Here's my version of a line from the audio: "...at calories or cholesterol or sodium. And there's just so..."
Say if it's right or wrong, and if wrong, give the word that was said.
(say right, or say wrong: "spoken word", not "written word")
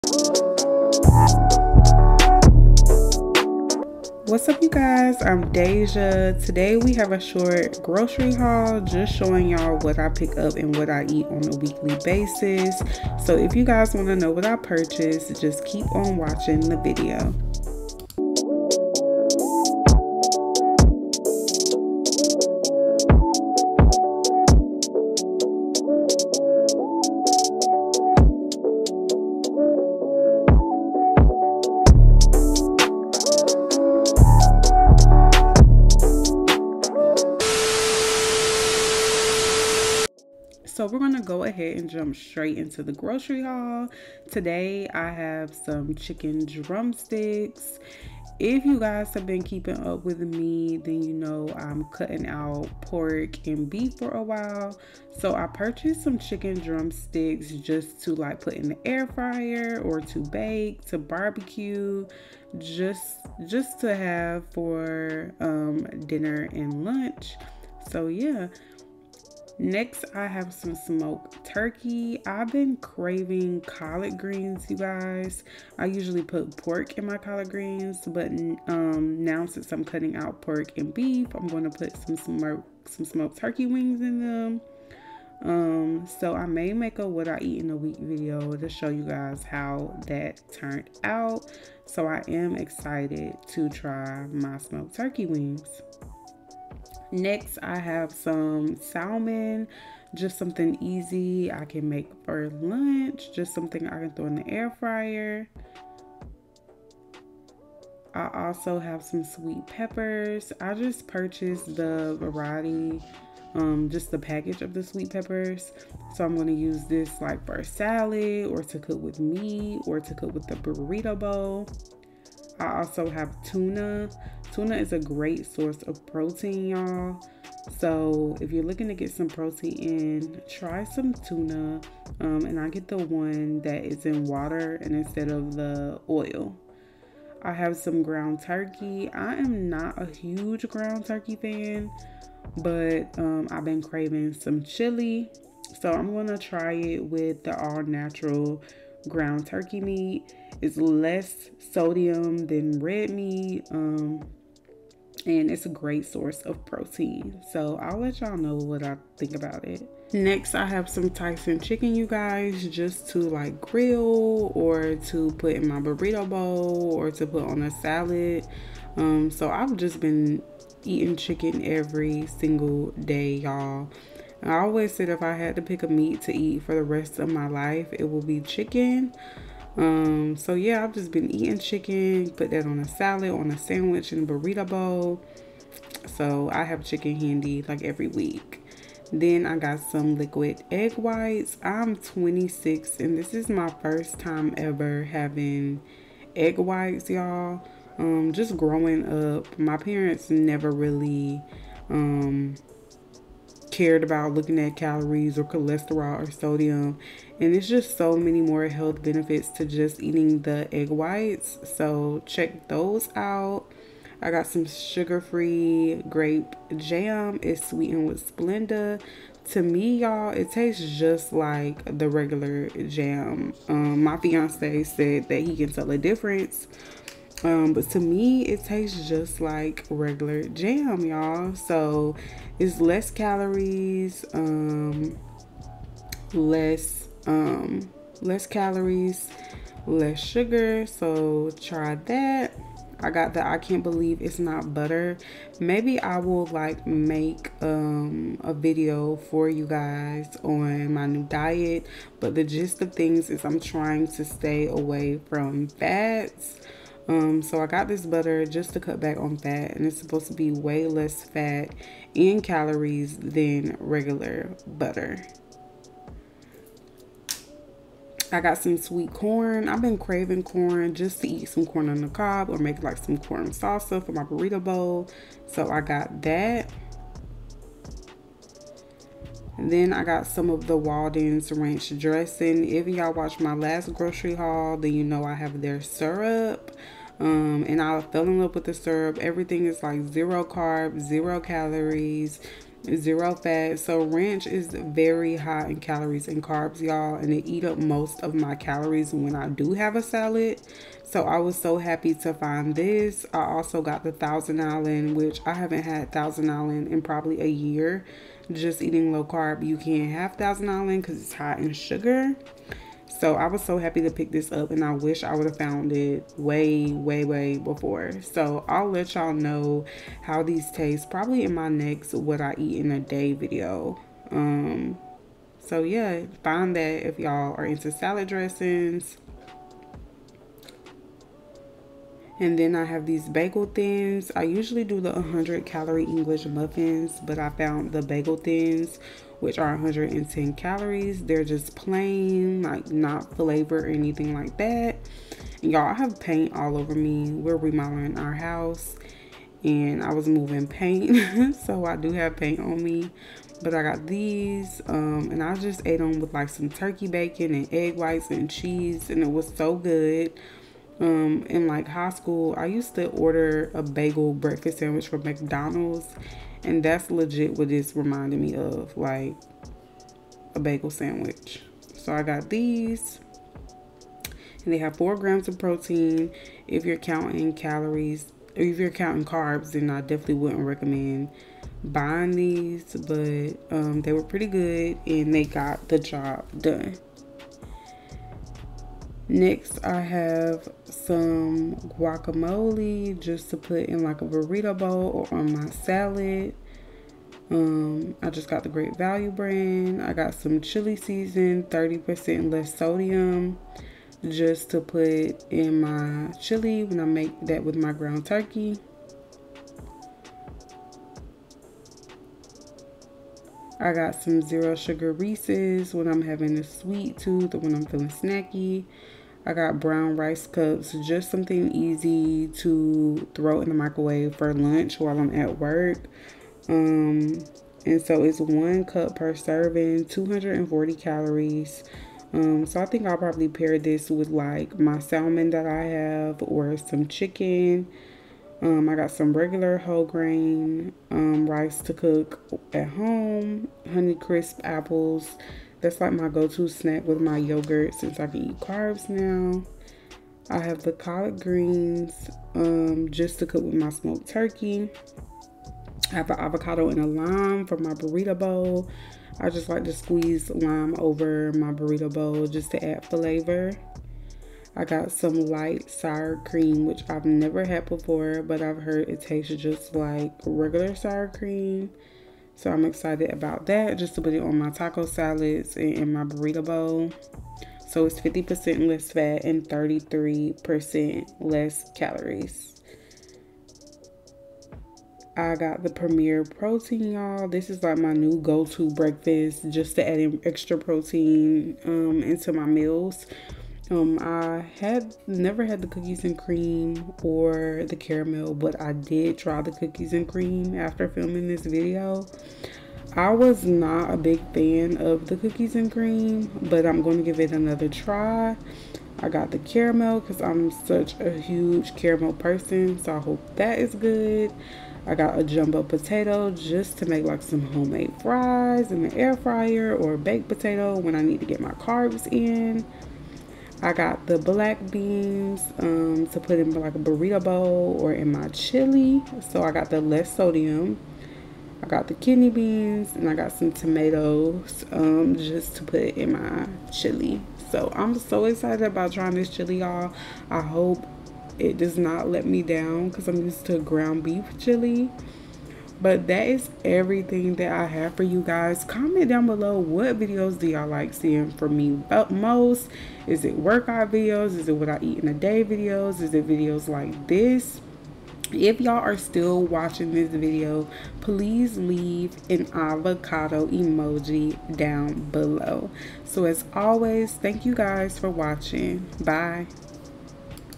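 right.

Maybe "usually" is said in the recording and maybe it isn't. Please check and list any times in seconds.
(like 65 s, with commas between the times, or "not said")
75 s, 334 s.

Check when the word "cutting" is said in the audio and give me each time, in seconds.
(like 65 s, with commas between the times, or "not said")
51 s, 79 s.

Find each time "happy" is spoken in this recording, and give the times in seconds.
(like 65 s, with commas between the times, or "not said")
301 s, 313 s.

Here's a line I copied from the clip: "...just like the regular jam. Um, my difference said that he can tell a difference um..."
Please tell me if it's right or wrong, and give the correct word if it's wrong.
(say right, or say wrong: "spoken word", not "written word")
wrong: "fiance", not "difference".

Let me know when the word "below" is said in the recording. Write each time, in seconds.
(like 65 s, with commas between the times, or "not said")
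549 s, 565 s.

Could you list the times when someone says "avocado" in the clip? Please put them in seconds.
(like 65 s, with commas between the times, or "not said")
456 s, 562 s.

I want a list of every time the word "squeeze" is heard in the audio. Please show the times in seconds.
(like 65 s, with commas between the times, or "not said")
459 s.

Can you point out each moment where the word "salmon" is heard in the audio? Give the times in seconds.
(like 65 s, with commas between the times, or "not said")
98 s, 434 s.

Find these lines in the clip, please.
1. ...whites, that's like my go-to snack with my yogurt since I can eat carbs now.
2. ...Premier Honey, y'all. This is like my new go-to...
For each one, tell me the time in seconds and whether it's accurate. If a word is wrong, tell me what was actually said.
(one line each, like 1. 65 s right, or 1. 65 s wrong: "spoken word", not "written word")
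1. 444 s wrong: "apples", not "whites"
2. 485 s wrong: "Protein", not "Honey".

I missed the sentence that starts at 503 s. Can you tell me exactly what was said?
I was not a big fan of the cookies and cream, but I'm going to give it another try.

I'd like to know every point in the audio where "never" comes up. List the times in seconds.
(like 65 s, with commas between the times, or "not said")
200 s, 467 s, 495 s.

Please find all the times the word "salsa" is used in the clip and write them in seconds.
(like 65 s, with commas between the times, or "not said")
273 s.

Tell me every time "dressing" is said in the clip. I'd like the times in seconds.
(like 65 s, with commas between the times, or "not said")
281 s, 328 s.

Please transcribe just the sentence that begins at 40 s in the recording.
so we're going to go ahead and jump straight into the grocery haul.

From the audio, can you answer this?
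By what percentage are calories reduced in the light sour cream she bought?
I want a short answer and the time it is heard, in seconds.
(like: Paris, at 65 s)
33%, at 479 s.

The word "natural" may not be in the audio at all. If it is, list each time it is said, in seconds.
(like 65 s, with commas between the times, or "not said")
147 s.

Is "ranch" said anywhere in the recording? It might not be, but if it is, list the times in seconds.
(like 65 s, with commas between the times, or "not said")
281 s, 294 s.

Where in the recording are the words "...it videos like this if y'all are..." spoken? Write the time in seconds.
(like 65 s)
556 s.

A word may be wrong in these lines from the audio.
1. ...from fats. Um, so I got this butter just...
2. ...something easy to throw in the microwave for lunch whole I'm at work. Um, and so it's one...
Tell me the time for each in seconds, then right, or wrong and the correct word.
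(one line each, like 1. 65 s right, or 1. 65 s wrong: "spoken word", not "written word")
1. 255 s right
2. 421 s wrong: "while", not "whole".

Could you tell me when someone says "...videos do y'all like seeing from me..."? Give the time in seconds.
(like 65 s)
550 s.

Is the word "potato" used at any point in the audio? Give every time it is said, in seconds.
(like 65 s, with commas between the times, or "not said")
515 s, 520 s.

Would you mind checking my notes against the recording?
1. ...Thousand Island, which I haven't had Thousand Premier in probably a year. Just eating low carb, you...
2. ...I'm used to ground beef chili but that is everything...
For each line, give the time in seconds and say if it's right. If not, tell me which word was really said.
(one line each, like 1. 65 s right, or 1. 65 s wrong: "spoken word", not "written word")
1. 304 s wrong: "Island", not "Premier"
2. 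543 s right.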